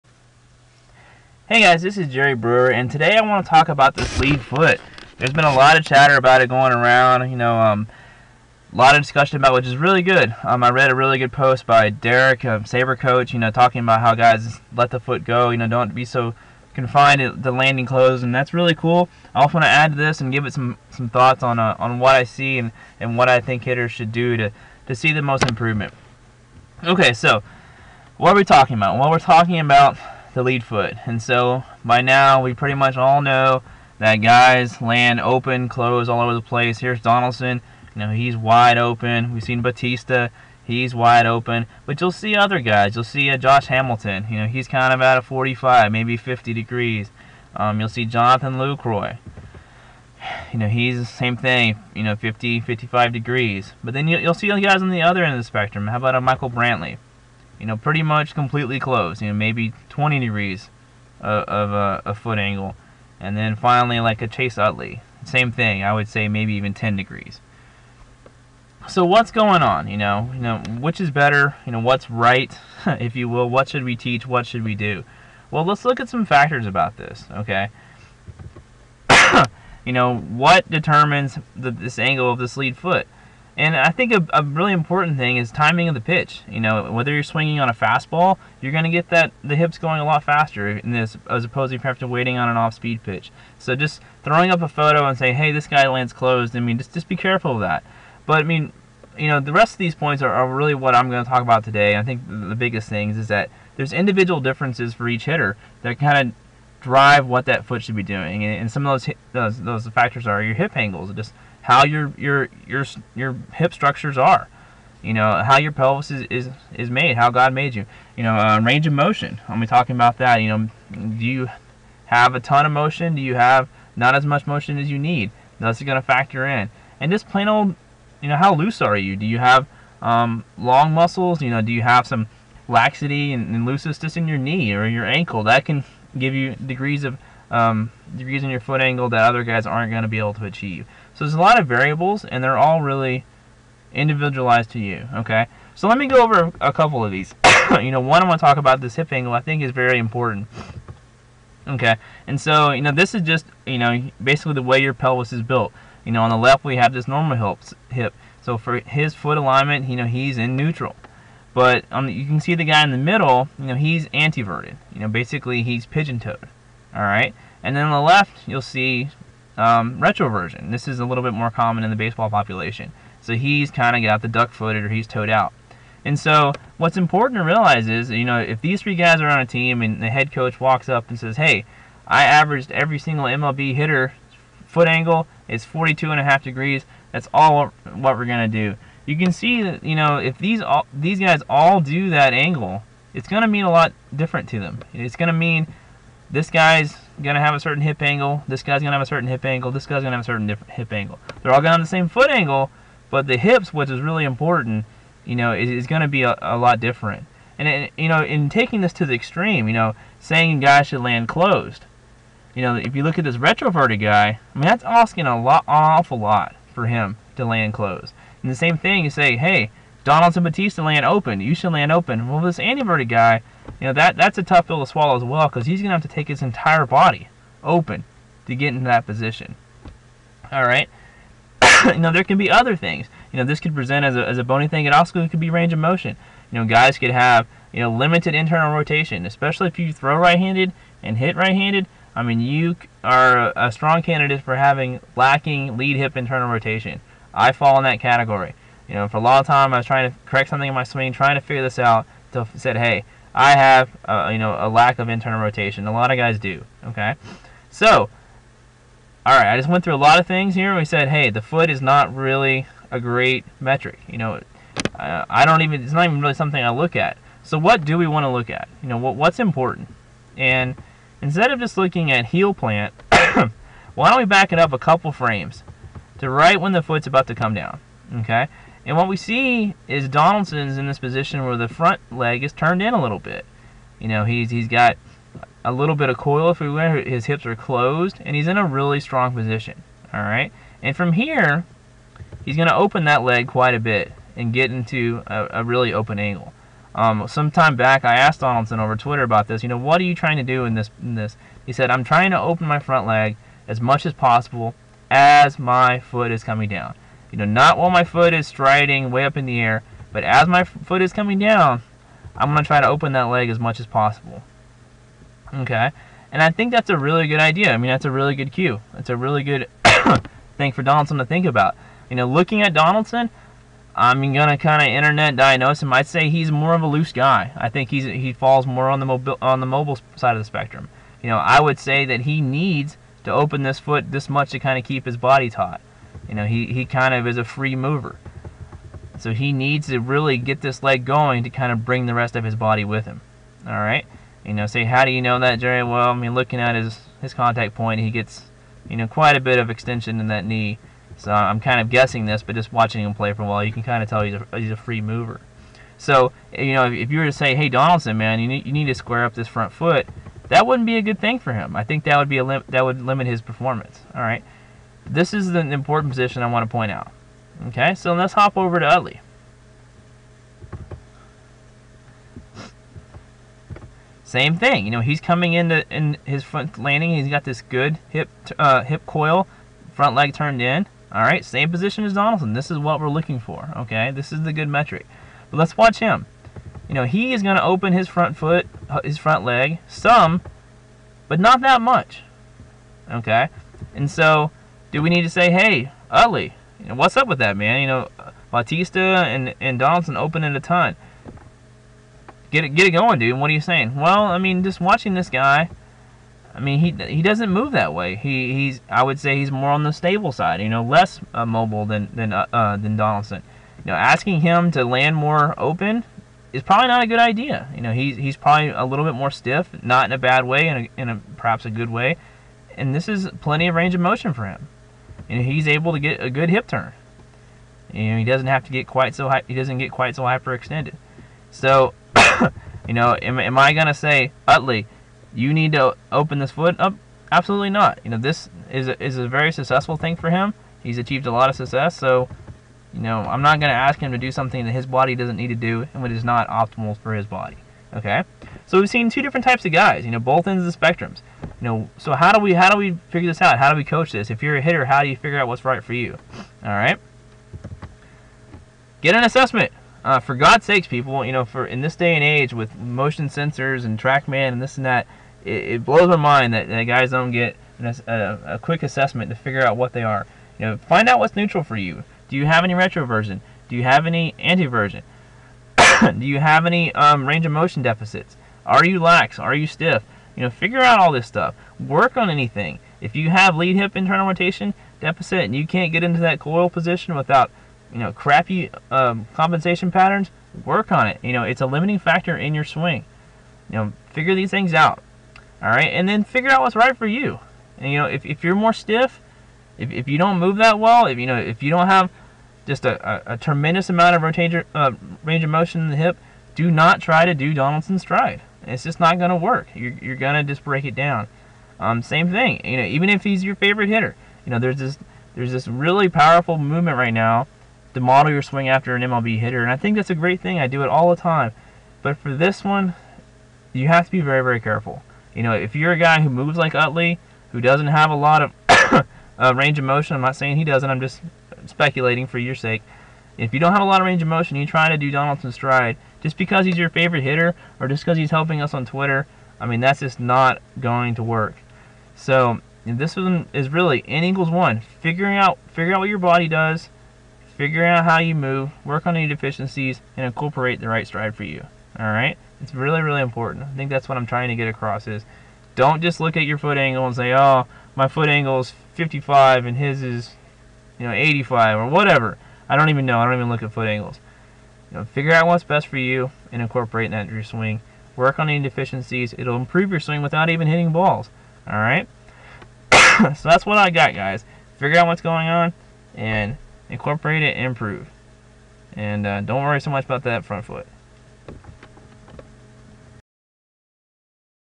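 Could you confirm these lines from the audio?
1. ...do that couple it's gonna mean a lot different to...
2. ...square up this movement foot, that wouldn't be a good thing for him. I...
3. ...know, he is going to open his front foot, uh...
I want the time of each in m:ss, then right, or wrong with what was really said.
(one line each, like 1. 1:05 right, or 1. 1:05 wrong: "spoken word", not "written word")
1. 3:11 wrong: "angle", not "couple"
2. 5:58 wrong: "front", not "movement"
3. 6:26 right.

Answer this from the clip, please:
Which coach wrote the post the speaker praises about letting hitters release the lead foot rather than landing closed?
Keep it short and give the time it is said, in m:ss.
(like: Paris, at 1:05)
Derek, at 0:11.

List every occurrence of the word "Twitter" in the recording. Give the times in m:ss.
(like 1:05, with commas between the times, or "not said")
4:58, 8:58.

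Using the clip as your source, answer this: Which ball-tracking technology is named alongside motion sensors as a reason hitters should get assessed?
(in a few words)
TrackMan.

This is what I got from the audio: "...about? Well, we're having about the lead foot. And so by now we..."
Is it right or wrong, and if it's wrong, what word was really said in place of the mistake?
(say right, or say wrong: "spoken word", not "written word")
wrong: "talking", not "having".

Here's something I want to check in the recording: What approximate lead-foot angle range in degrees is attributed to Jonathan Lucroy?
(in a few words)
50 to 55 degrees.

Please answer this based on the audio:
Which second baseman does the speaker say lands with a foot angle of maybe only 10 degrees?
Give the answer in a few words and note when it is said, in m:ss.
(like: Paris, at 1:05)
Chase Utley, at 1:04.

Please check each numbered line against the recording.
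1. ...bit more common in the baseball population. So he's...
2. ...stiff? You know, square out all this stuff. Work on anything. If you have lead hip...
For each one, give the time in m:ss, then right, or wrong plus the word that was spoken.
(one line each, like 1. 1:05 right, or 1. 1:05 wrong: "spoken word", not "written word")
1. 2:51 right
2. 7:59 wrong: "figure", not "square".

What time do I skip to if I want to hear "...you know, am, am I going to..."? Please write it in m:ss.
7:12.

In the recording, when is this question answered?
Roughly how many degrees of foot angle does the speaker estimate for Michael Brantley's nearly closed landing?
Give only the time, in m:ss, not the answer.
0:59.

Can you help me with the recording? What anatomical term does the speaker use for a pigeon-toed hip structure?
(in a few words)
Anteverted.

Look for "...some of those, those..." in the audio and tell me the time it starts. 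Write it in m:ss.
1:48.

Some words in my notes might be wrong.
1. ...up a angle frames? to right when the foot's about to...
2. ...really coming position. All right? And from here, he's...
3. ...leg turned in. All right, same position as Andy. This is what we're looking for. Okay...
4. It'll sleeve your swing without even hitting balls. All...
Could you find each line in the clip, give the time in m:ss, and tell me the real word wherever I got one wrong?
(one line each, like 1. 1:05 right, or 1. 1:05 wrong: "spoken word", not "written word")
1. 4:34 wrong: "couple", not "angle"
2. 4:48 wrong: "strong", not "coming"
3. 6:20 wrong: "Donaldson", not "Andy"
4. 9:29 wrong: "improve", not "sleeve".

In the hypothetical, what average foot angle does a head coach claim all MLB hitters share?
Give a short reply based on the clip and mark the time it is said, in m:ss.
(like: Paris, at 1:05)
42.5 degrees, at 3:05.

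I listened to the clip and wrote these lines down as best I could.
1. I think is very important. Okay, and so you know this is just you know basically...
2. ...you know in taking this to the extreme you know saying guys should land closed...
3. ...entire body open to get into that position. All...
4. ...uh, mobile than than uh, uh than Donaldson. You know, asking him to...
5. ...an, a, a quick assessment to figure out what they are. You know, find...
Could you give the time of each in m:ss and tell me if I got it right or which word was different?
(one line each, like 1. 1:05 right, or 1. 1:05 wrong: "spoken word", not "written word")
1. 2:29 right
2. 3:27 right
3. 3:46 right
4. 6:51 right
5. 7:47 right.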